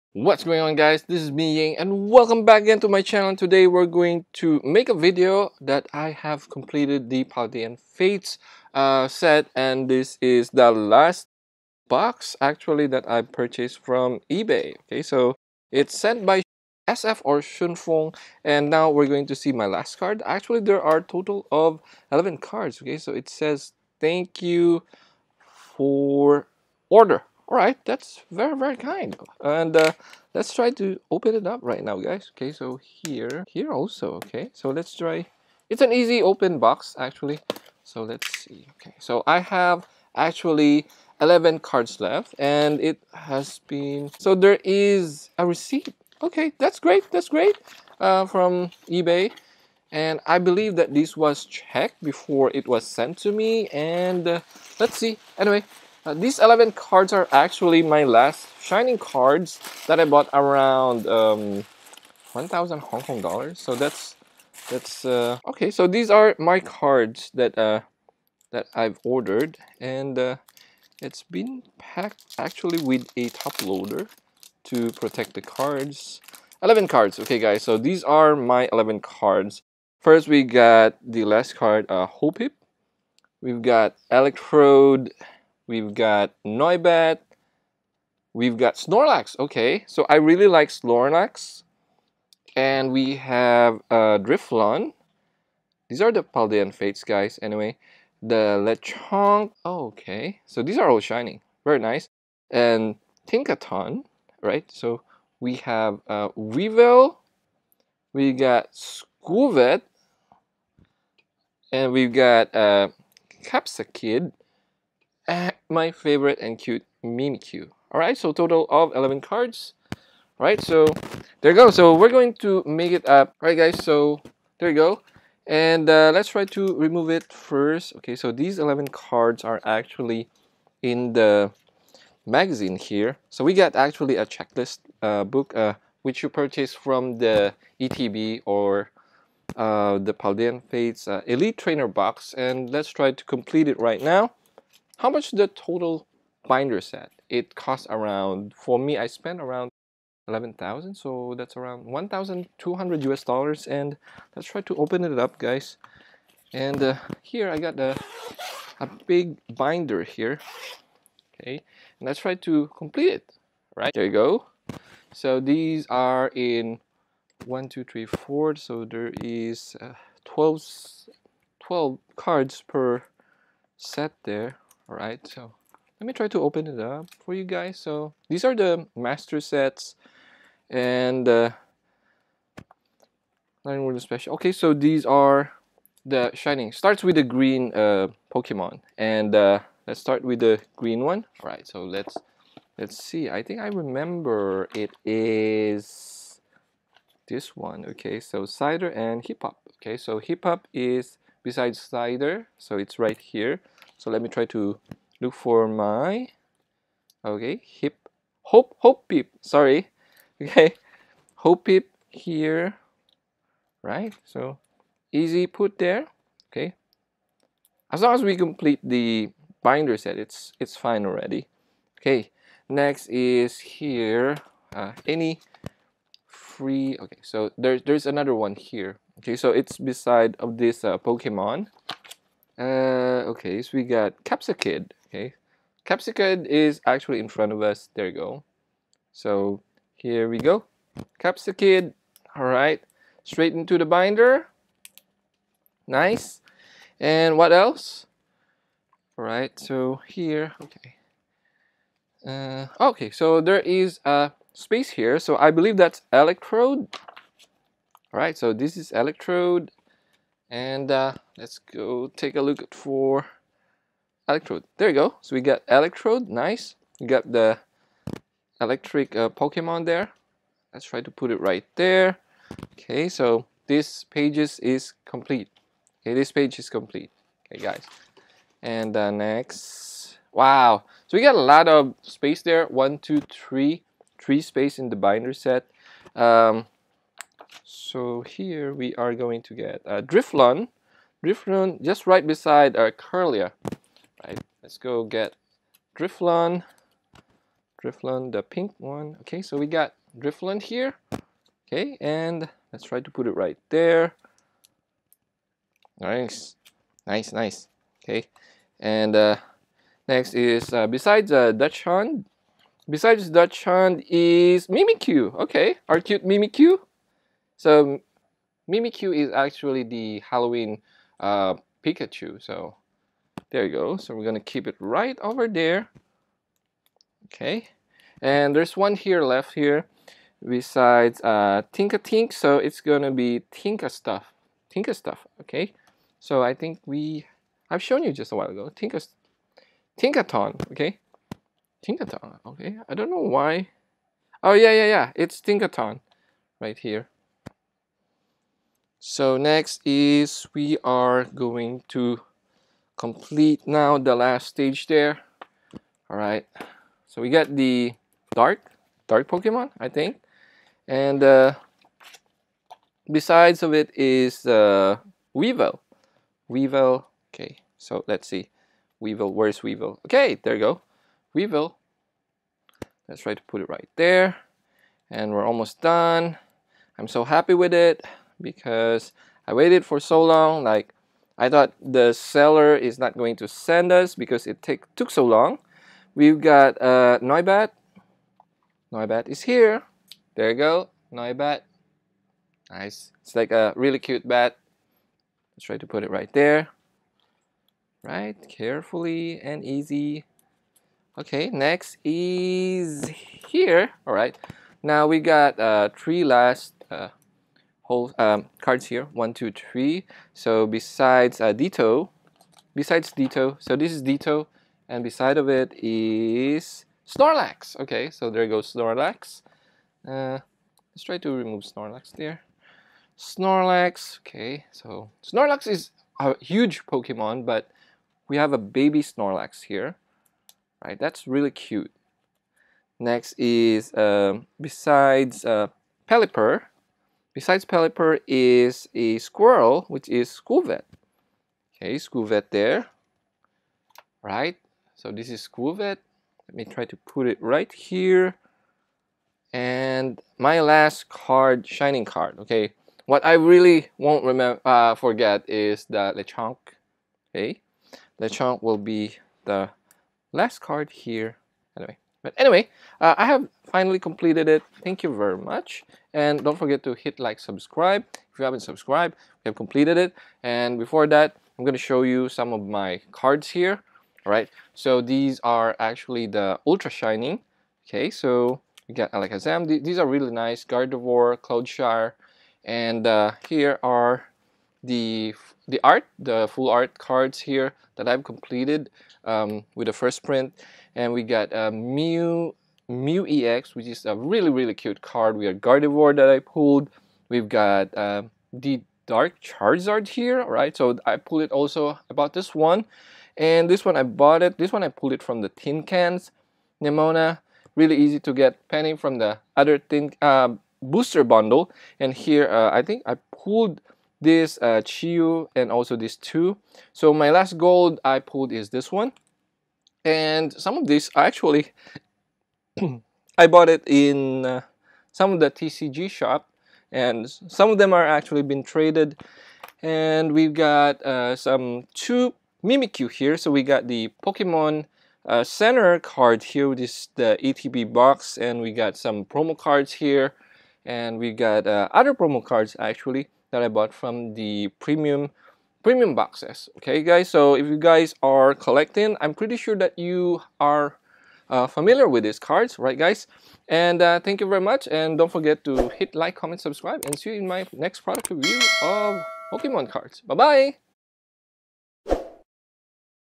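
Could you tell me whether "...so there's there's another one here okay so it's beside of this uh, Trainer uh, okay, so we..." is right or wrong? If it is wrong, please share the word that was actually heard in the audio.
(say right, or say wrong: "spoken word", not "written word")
wrong: "Pokemon", not "Trainer".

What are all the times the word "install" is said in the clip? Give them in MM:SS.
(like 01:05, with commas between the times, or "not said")
not said.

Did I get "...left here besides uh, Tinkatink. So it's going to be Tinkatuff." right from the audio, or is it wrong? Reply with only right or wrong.
right.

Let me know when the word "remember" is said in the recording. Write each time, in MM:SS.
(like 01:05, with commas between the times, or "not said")
03:13, 07:34.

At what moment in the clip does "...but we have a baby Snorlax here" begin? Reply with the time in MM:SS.
07:07.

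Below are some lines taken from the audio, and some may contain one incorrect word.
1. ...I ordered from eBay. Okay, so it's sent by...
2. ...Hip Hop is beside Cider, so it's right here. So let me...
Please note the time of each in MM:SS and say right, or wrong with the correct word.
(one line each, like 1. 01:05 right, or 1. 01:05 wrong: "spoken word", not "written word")
1. 00:13 wrong: "purchased", not "ordered"
2. 03:20 right.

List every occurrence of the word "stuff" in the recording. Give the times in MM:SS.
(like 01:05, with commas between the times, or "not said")
05:34.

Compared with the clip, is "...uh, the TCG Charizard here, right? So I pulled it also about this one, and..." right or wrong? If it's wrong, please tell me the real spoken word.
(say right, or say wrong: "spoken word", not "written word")
wrong: "Dark", not "TCG".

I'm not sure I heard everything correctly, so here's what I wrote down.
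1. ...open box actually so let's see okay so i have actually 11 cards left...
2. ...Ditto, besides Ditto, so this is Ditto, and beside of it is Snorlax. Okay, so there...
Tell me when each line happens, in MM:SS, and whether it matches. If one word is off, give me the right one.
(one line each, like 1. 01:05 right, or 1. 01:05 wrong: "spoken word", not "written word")
1. 00:36 right
2. 06:51 right.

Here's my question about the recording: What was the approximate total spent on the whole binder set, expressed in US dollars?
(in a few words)
1,200 US dollars.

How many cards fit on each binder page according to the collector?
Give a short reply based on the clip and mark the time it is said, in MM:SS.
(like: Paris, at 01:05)
12, at 02:50.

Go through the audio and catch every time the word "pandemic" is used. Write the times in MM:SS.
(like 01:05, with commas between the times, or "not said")
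not said.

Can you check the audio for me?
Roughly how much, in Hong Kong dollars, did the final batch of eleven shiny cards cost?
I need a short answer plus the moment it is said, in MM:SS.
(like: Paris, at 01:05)
1,000 Hong Kong dollars, at 01:02.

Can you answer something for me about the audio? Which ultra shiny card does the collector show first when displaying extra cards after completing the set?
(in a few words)
Alakazam.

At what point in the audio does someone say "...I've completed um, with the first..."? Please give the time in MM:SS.
08:08.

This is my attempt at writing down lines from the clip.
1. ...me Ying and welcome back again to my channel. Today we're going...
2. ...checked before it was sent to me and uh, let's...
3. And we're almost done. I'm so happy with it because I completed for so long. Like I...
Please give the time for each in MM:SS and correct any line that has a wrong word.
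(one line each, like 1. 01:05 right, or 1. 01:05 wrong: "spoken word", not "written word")
1. 00:01 right
2. 00:51 right
3. 06:15 wrong: "waited", not "completed".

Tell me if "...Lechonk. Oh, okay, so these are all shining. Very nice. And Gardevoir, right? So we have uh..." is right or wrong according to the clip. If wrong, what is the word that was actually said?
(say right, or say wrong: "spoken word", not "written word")
wrong: "Tinkaton", not "Gardevoir".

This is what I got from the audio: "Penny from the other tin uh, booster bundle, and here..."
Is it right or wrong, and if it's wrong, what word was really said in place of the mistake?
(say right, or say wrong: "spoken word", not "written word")
right.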